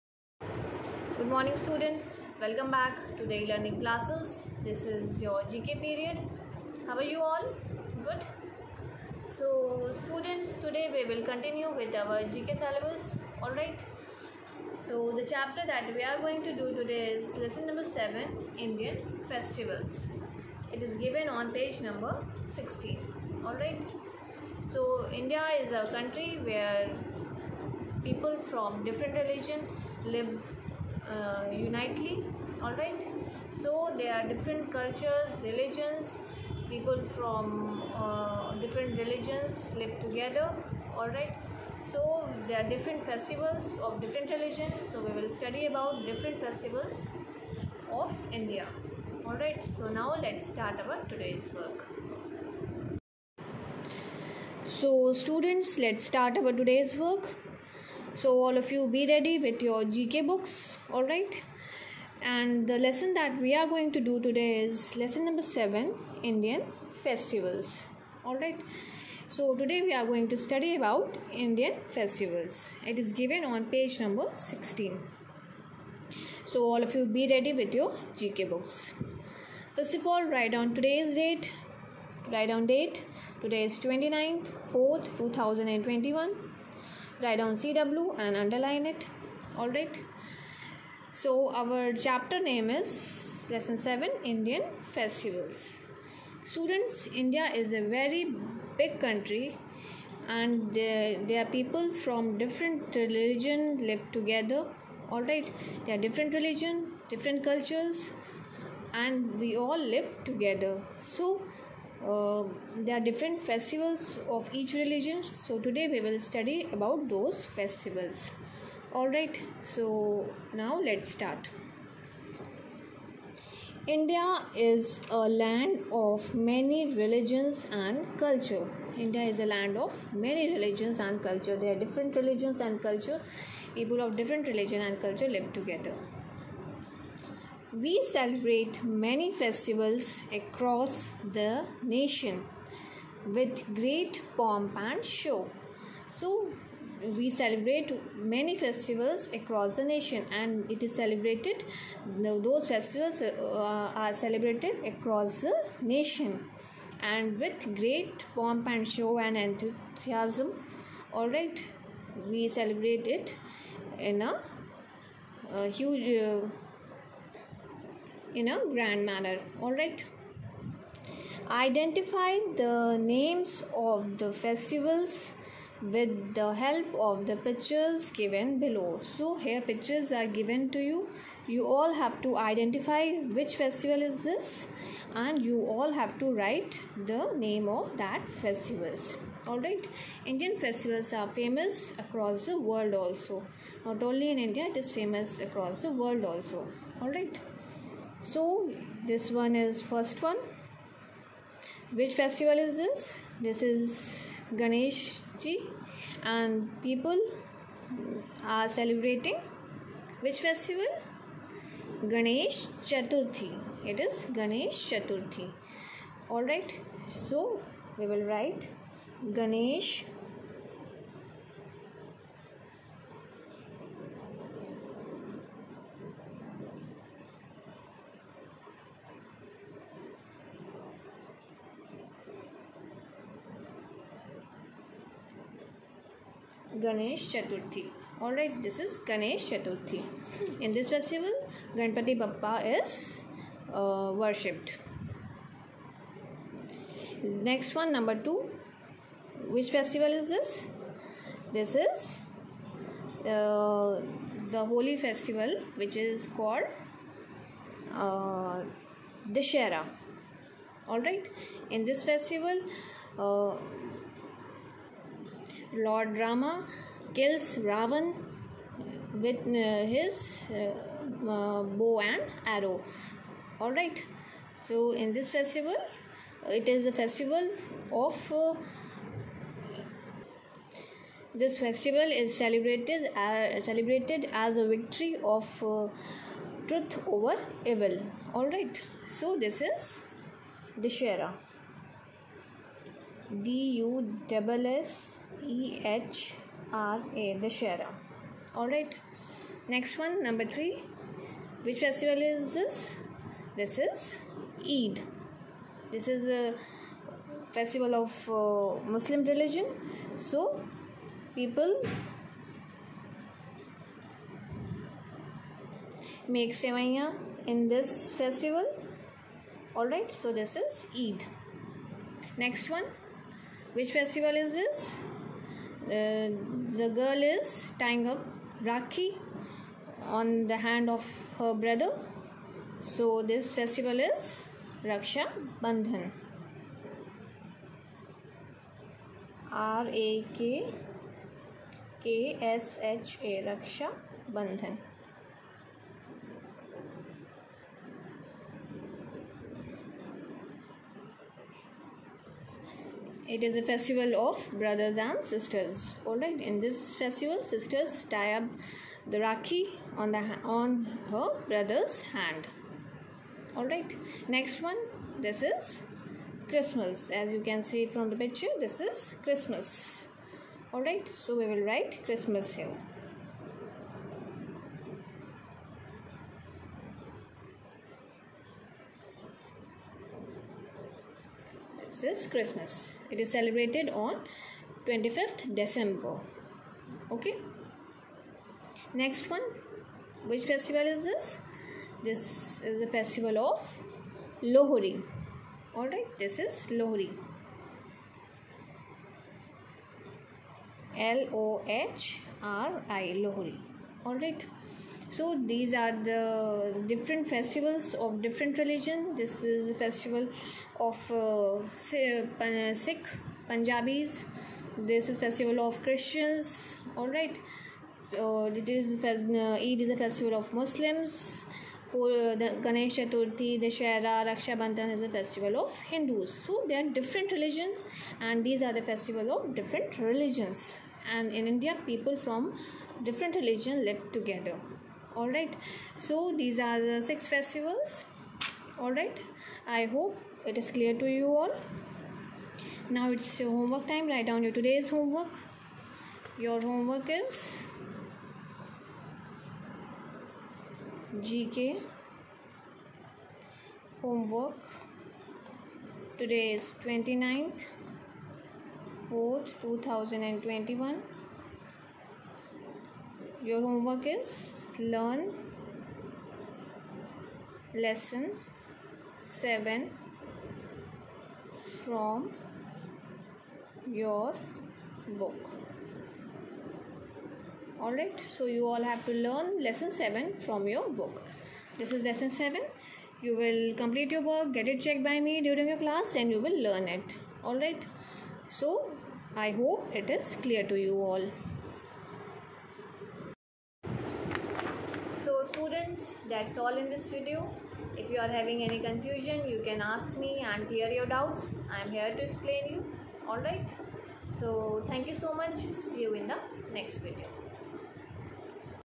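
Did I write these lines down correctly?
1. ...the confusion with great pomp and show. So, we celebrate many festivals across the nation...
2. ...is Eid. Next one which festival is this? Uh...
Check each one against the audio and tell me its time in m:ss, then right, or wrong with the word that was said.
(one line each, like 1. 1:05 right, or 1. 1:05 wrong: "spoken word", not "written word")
1. 2:21 wrong: "nation", not "confusion"
2. 5:20 right.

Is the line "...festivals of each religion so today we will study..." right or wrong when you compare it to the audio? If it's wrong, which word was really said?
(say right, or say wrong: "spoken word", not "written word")
right.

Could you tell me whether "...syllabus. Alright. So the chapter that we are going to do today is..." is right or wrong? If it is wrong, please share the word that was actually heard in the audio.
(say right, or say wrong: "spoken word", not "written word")
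right.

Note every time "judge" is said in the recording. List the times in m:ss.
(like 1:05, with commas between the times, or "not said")
not said.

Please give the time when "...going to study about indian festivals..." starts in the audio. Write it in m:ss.
1:10.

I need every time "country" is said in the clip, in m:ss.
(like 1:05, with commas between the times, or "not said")
0:25, 1:38.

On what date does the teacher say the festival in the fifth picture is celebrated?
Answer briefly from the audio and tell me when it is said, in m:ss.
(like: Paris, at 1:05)
25 December, at 6:24.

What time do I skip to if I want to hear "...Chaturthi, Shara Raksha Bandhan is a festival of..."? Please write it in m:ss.
7:02.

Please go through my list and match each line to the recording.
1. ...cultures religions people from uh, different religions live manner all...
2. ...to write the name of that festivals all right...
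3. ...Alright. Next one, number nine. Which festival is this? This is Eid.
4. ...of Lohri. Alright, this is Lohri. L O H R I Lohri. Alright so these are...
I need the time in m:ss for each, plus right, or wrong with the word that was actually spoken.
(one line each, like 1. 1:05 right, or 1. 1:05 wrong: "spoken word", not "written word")
1. 0:34 wrong: "together", not "manner"
2. 3:06 right
3. 4:58 wrong: "three", not "nine"
4. 6:33 right.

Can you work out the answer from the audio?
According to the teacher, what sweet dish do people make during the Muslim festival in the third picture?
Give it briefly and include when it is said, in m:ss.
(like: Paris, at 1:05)
Sevaiya, at 5:16.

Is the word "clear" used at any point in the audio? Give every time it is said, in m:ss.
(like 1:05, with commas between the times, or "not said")
7:20, 8:10, 8:20.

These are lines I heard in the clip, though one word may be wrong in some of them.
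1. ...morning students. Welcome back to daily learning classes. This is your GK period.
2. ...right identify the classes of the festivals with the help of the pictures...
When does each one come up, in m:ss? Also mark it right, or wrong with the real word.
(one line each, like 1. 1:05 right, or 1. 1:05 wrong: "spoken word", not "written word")
1. 0:01 right
2. 2:49 wrong: "names", not "classes".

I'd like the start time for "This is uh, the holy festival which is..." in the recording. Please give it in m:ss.
4:11.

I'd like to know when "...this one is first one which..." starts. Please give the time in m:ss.
3:19.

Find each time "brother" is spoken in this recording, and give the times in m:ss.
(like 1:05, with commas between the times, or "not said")
5:31, 5:54, 6:01.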